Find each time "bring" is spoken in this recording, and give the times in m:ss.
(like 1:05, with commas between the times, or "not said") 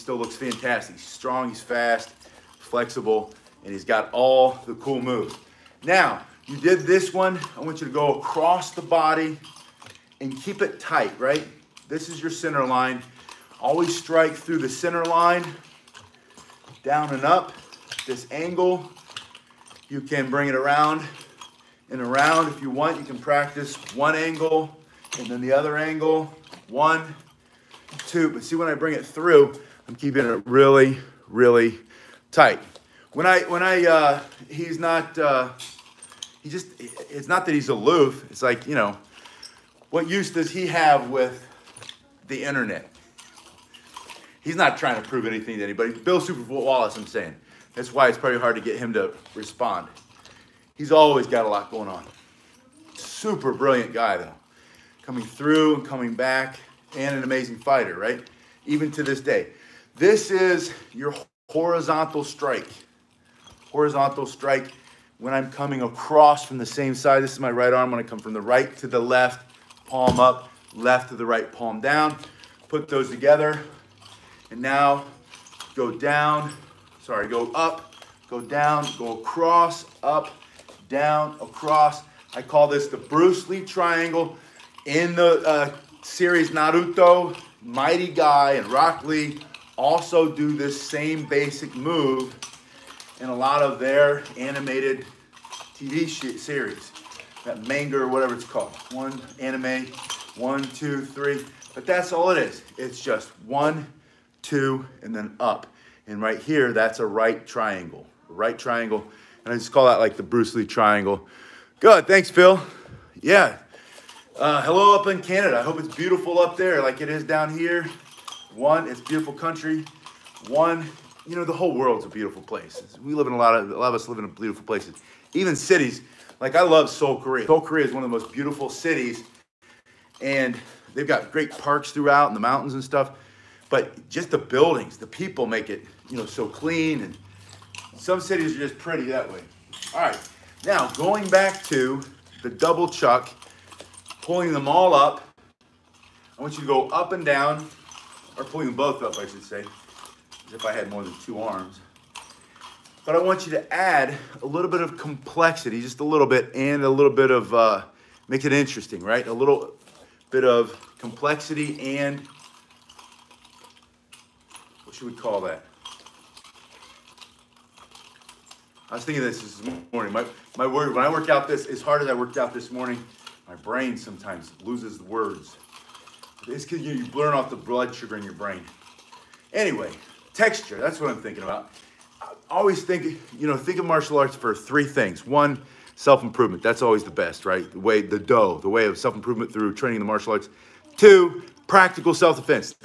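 0:20, 0:28.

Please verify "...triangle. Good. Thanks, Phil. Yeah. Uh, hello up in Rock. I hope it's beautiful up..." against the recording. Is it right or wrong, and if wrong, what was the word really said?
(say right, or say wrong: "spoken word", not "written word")
wrong: "Canada", not "Rock".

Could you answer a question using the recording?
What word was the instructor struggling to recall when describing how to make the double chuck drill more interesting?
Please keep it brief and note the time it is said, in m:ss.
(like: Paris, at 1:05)
Texture, at 3:00.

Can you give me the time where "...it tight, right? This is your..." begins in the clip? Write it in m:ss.
0:10.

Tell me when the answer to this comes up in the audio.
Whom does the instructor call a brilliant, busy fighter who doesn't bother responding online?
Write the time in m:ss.
0:45.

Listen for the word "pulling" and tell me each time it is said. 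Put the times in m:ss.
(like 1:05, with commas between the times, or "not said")
2:24, 2:28.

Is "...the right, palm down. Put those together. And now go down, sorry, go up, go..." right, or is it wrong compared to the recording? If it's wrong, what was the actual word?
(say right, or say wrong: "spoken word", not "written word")
right.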